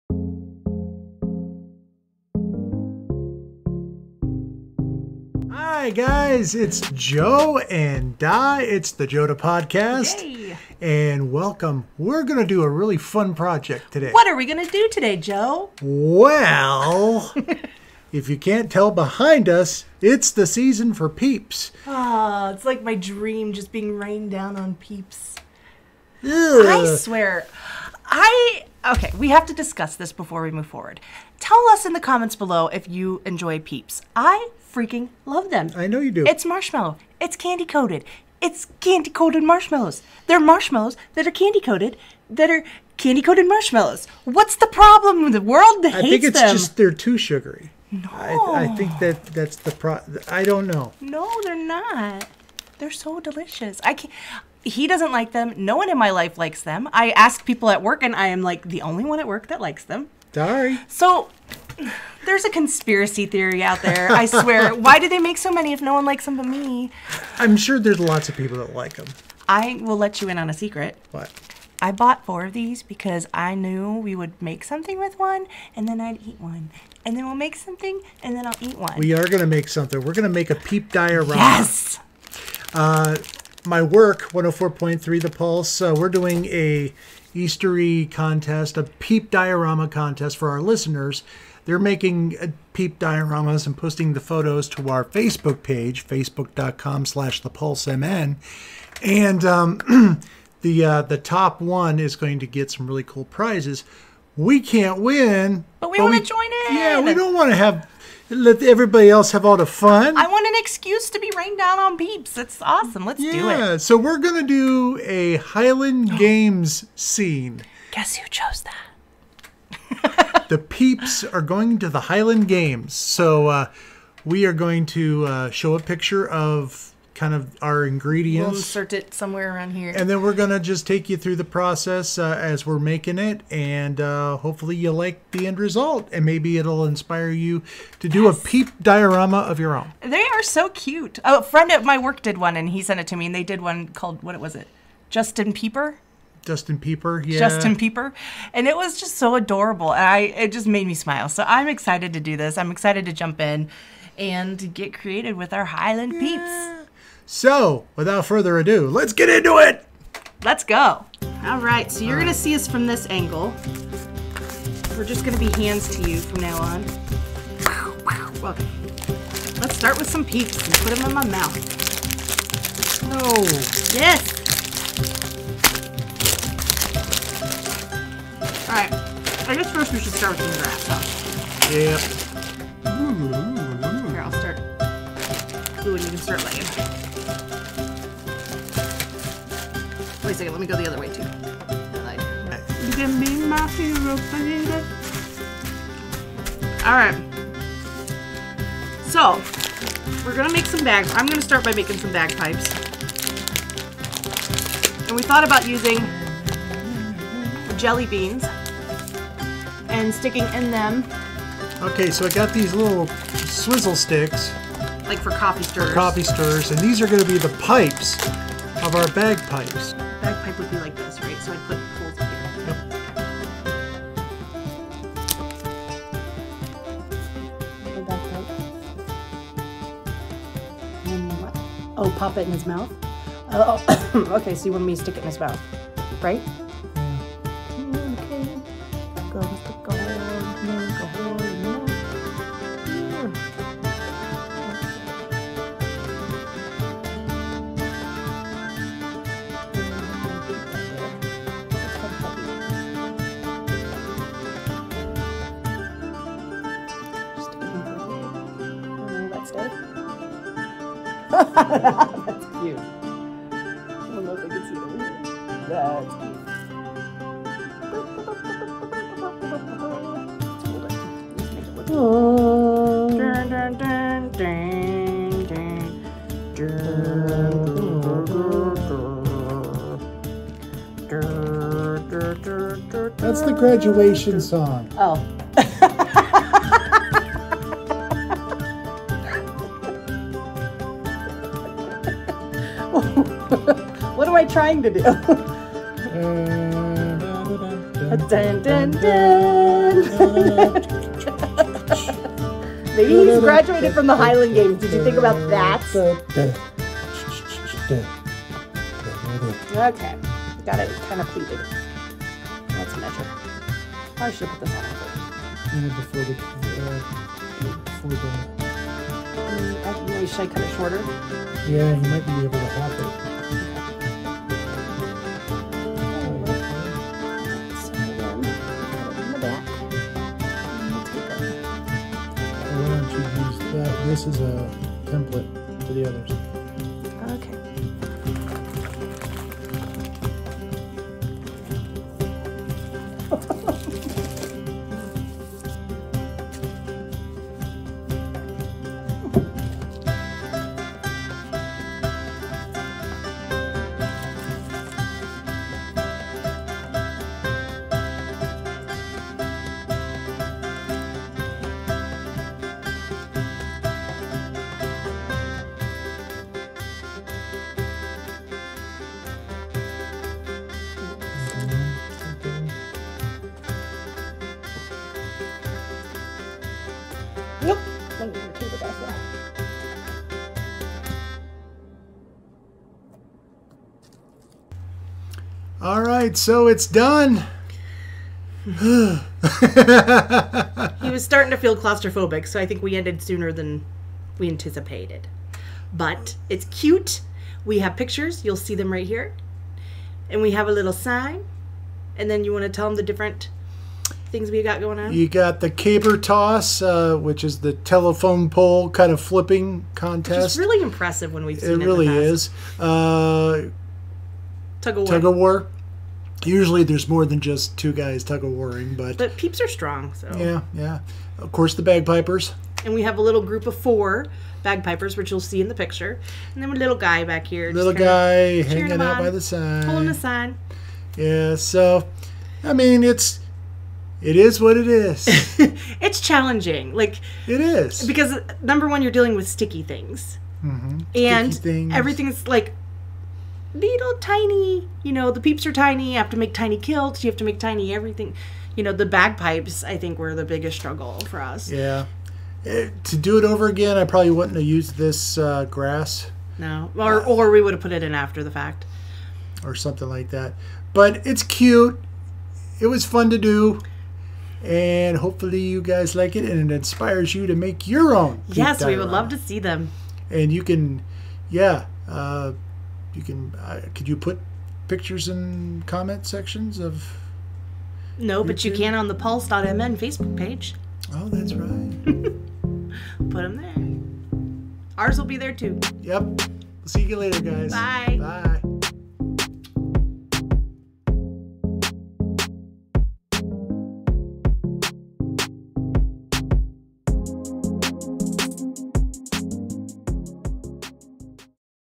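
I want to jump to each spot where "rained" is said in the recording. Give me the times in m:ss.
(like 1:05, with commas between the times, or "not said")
0:23, 1:51.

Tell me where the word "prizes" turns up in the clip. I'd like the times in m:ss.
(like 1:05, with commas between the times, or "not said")
1:43.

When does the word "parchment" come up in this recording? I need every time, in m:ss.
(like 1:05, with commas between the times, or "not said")
not said.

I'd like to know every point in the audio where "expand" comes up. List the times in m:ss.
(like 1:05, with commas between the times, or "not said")
not said.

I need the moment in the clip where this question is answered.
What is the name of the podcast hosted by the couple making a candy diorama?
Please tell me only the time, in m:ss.
0:09.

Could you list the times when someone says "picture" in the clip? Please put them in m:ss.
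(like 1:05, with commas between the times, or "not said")
2:05, 6:37, 7:05, 7:54.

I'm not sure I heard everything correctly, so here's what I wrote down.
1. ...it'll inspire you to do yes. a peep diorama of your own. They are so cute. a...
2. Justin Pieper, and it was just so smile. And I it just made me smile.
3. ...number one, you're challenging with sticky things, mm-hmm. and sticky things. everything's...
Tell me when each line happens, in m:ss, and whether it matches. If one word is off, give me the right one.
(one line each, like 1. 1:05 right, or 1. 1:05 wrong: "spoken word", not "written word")
1. 2:16 right
2. 2:27 wrong: "adorable", not "smile"
3. 7:18 wrong: "dealing", not "challenging".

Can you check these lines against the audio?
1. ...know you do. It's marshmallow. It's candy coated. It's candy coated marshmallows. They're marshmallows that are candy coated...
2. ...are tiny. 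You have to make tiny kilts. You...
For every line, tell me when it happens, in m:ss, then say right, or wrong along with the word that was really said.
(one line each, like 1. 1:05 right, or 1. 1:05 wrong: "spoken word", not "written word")
1. 0:35 right
2. 7:25 right.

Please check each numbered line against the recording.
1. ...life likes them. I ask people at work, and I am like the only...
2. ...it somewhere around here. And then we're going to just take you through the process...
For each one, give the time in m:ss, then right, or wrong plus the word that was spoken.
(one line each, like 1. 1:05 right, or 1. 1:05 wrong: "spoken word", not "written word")
1. 0:56 right
2. 2:08 right.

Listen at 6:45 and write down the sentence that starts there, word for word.
You got the caber toss, uh, which is the telephone pole kind of flipping contest.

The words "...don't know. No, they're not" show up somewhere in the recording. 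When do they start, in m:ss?
0:50.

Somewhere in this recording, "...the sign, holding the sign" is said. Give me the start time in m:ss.
7:09.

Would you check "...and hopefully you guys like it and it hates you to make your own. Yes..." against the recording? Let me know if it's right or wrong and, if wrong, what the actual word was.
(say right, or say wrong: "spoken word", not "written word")
wrong: "inspires", not "hates".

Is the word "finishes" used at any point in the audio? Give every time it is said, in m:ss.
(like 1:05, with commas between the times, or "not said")
not said.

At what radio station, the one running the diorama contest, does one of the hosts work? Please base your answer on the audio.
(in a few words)
104.3 The Pulse.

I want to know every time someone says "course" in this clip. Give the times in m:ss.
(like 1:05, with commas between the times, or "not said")
7:01.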